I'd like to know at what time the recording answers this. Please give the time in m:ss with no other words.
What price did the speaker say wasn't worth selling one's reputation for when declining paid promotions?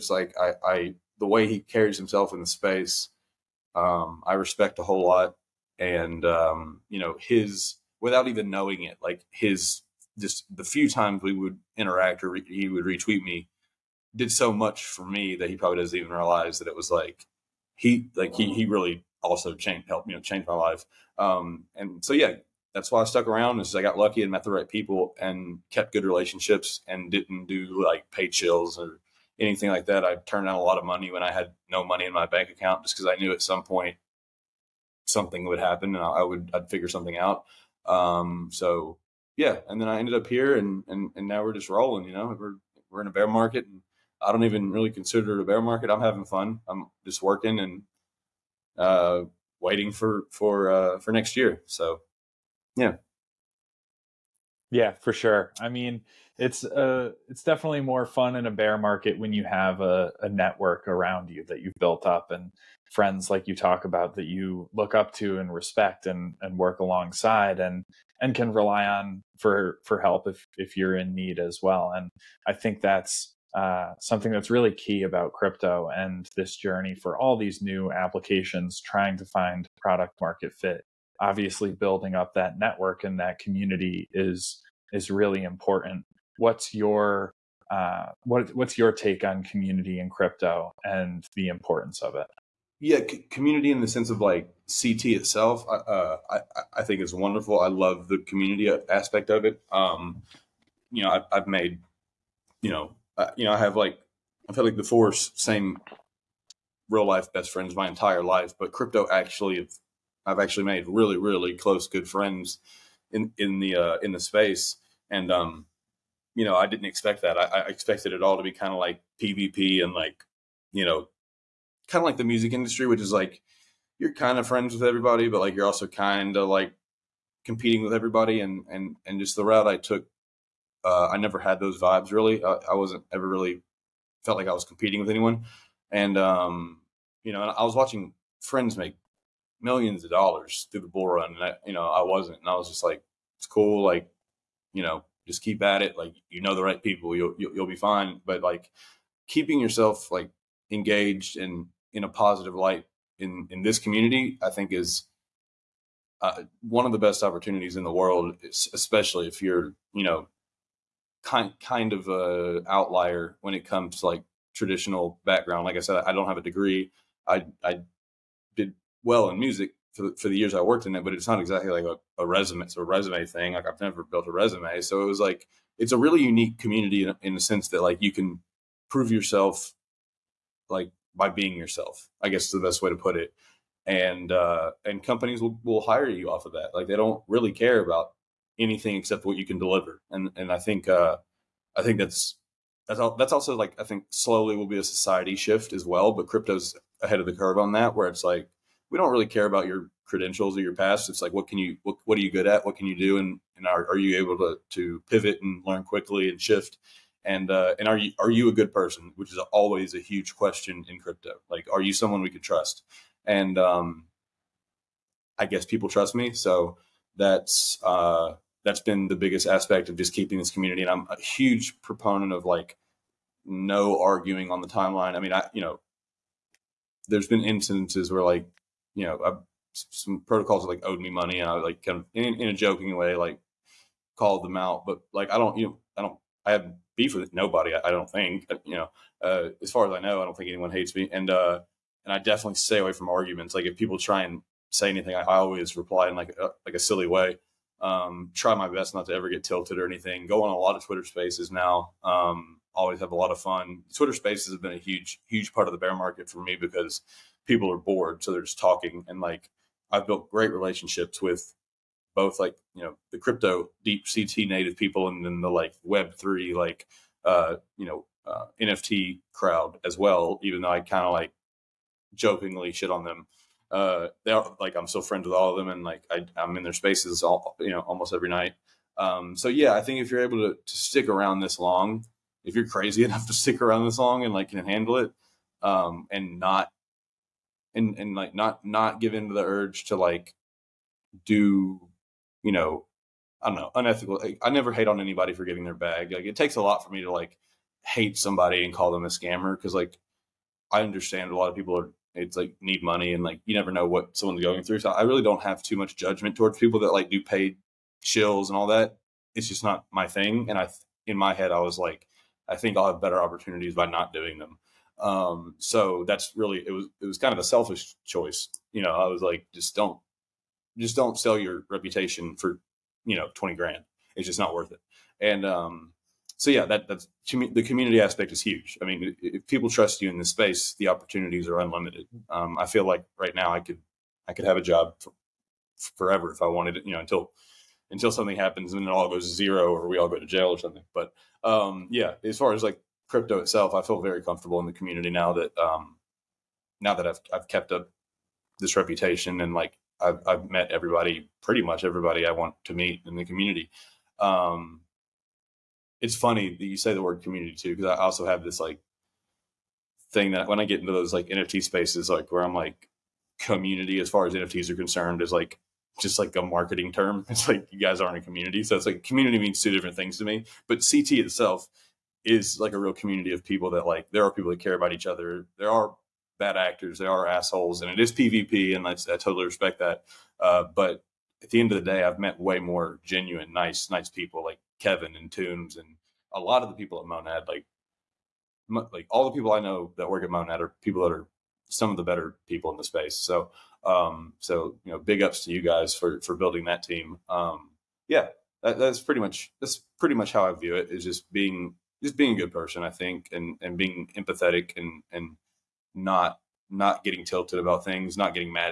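5:23.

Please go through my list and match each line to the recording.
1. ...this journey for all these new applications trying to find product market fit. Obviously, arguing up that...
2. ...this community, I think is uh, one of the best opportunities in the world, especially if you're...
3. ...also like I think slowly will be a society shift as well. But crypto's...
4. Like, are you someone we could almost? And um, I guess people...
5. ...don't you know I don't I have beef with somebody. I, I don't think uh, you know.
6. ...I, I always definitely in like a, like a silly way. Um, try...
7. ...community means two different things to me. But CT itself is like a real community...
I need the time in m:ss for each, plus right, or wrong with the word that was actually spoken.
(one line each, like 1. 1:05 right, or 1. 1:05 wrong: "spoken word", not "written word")
1. 1:16 wrong: "building", not "arguing"
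2. 2:33 right
3. 3:13 right
4. 3:31 wrong: "trust", not "almost"
5. 3:55 wrong: "nobody", not "somebody"
6. 4:05 wrong: "reply", not "definitely"
7. 6:09 right.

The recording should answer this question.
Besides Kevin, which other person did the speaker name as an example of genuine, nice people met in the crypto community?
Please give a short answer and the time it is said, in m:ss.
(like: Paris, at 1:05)
Toombs, at 6:25.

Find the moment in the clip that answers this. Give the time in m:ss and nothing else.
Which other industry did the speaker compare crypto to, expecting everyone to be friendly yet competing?
2:02.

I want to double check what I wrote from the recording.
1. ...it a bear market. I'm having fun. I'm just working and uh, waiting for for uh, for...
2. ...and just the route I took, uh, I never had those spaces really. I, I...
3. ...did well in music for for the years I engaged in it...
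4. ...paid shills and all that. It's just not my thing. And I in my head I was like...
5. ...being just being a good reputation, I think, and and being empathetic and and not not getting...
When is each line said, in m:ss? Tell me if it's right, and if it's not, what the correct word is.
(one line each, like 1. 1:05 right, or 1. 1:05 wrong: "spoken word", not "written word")
1. 0:45 right
2. 2:09 wrong: "vibes", not "spaces"
3. 2:48 wrong: "worked", not "engaged"
4. 5:07 right
5. 6:41 wrong: "person", not "reputation".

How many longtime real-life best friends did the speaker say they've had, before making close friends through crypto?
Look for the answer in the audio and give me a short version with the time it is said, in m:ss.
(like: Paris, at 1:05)
4, at 1:44.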